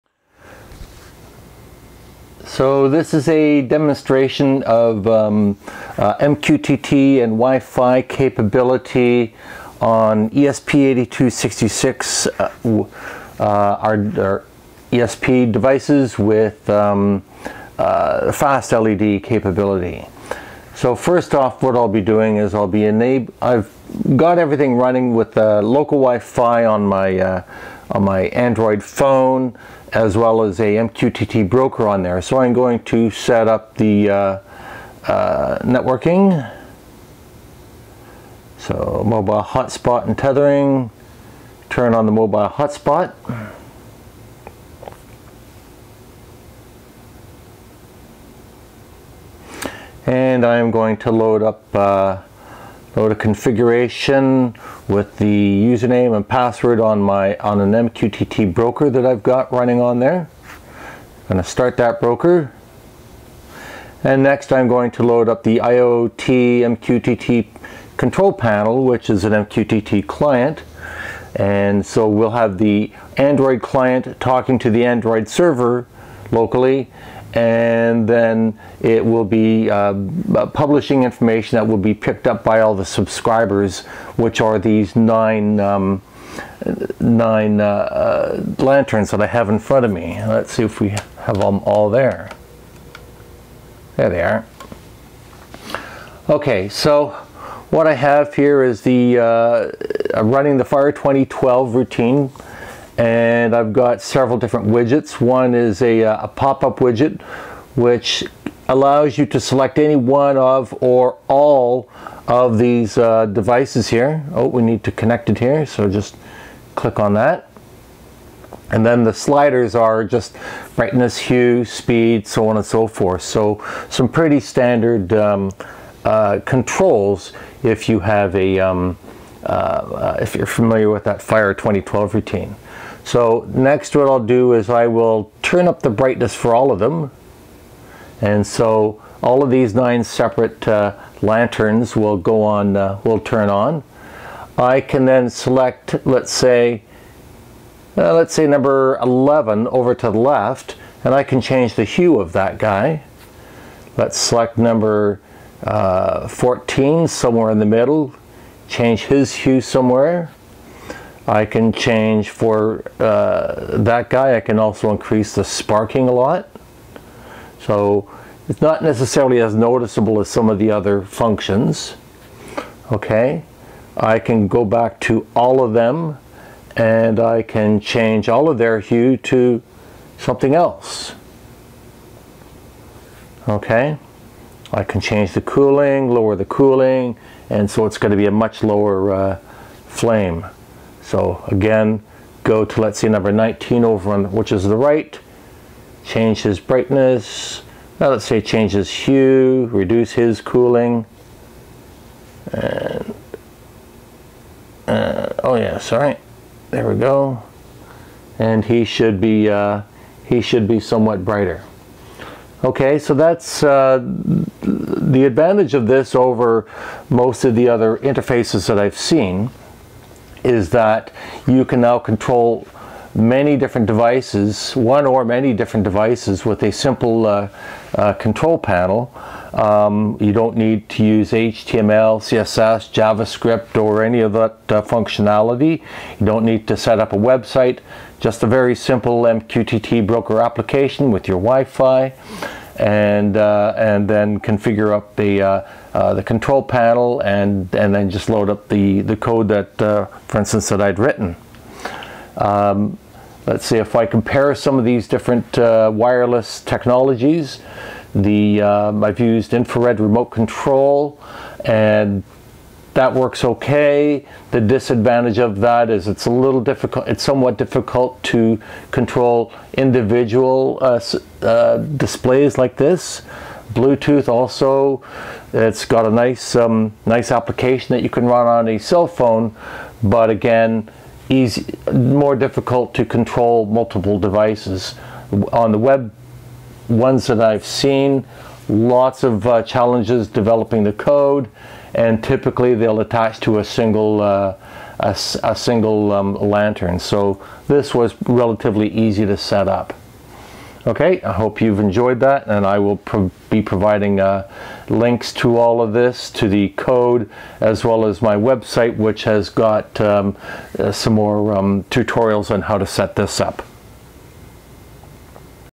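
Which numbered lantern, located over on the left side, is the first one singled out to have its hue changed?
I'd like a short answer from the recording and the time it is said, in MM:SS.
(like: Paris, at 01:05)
11, at 02:28.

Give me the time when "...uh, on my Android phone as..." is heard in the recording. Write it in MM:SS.
00:27.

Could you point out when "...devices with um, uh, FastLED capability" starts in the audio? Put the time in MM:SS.
00:15.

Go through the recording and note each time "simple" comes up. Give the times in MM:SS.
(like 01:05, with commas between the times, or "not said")
03:46, 03:58.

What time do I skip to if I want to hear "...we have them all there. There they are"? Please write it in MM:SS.
01:30.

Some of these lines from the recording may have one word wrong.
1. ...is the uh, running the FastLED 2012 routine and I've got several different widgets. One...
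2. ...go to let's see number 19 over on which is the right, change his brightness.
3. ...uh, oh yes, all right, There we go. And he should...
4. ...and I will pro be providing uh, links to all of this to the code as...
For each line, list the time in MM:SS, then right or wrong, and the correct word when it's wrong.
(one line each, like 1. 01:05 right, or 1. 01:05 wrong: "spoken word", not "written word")
1. 01:38 wrong: "Fire", not "FastLED"
2. 03:12 right
3. 03:24 right
4. 05:02 right.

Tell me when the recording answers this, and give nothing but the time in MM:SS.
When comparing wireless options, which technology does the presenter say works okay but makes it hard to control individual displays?
04:19.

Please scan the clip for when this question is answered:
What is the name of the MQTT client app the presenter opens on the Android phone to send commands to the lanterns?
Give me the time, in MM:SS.
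01:05.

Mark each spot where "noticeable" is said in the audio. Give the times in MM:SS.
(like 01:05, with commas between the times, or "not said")
02:49.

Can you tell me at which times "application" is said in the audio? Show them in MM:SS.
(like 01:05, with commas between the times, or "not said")
04:00, 04:37.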